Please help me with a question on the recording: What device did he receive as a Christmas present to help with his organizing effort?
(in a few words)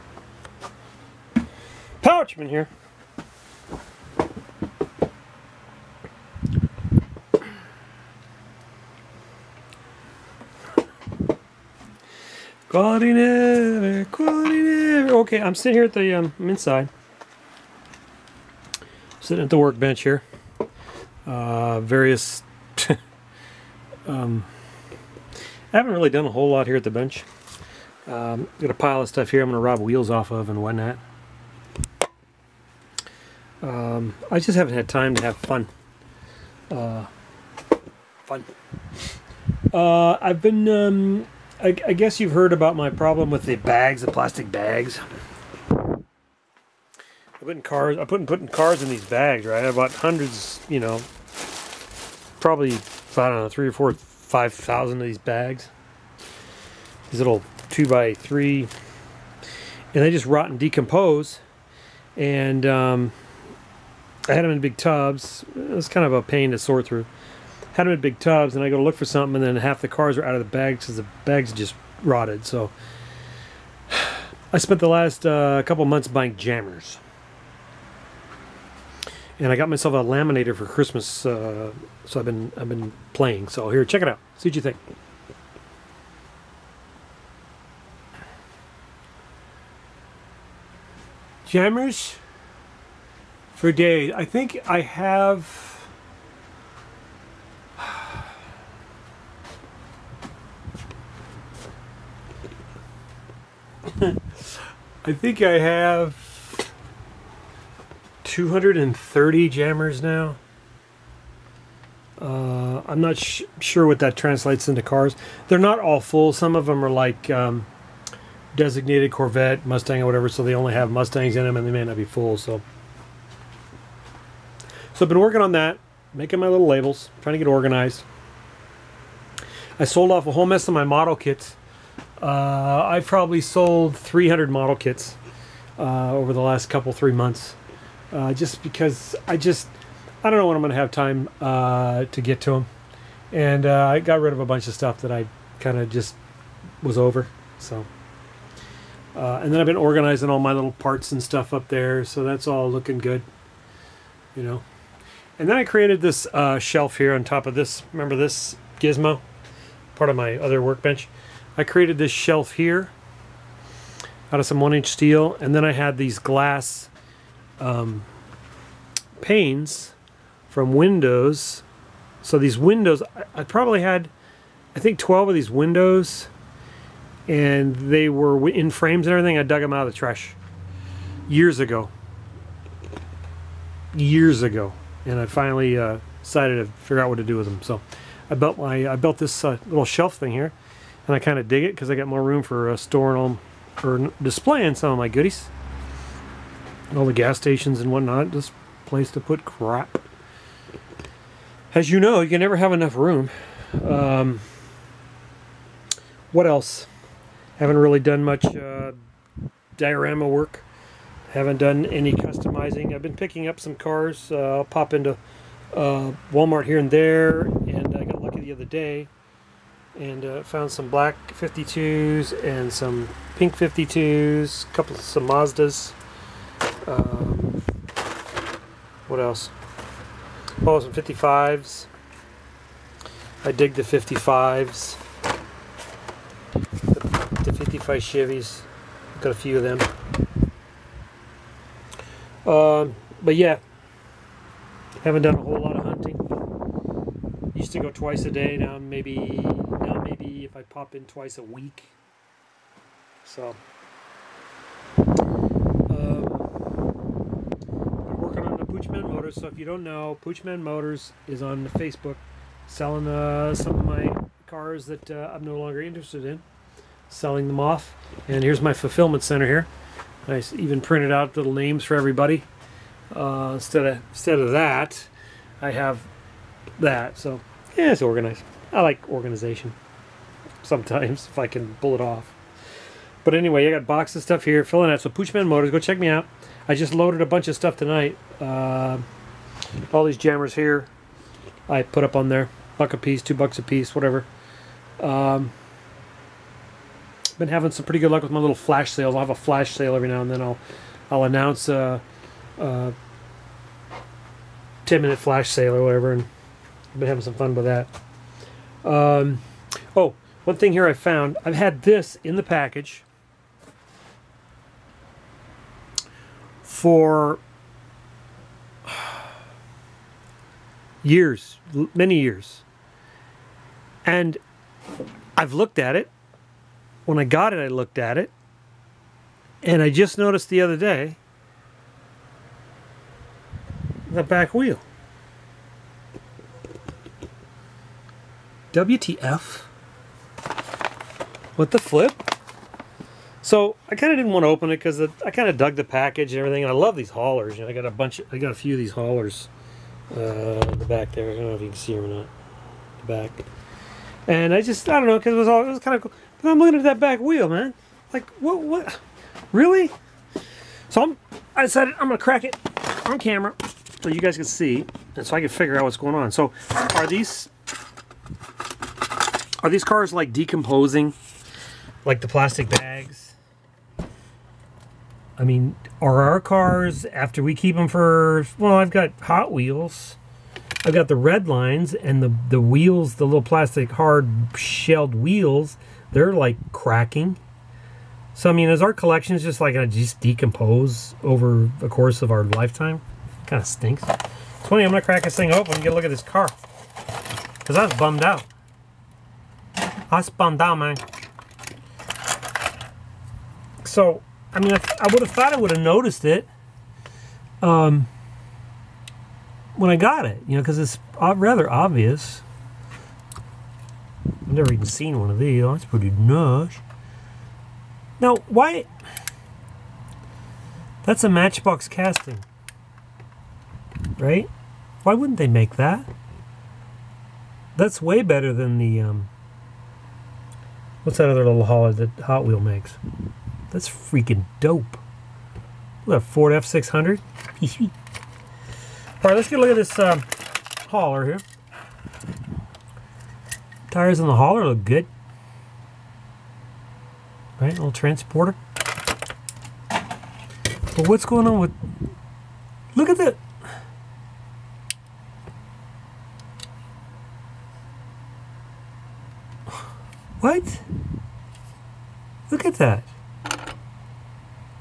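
laminator.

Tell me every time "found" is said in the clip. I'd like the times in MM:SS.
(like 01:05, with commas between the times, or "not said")
03:40, 05:10.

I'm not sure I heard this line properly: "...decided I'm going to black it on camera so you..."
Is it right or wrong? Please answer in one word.
wrong.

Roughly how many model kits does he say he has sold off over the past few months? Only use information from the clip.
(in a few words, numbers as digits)
300.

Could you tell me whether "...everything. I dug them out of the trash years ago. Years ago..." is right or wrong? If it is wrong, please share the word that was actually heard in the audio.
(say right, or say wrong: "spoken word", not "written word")
right.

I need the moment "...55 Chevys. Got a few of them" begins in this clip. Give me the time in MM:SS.
03:57.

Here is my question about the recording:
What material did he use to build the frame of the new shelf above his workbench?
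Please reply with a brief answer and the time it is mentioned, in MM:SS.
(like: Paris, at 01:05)
one inch steel, at 02:44.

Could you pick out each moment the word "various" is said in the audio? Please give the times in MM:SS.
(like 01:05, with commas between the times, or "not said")
00:21.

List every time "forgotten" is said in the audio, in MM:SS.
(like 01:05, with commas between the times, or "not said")
not said.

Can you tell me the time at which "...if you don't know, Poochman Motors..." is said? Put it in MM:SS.
04:19.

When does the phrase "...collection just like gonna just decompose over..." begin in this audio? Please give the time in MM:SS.
06:28.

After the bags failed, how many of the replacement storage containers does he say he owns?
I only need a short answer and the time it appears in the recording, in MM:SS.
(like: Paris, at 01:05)
230, at 01:48.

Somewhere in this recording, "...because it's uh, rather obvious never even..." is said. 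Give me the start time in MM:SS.
06:50.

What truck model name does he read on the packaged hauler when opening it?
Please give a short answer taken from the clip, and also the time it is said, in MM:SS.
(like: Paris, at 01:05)
Ford F600, at 07:16.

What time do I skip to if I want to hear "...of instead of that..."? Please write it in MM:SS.
04:33.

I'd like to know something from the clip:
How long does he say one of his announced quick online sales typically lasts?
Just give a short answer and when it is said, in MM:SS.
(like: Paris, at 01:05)
10 minutes, at 05:04.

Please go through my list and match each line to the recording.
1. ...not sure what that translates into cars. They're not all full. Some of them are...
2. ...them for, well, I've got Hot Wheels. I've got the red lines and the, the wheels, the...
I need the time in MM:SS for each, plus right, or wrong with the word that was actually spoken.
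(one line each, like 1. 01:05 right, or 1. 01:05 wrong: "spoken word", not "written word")
1. 01:53 right
2. 06:17 right.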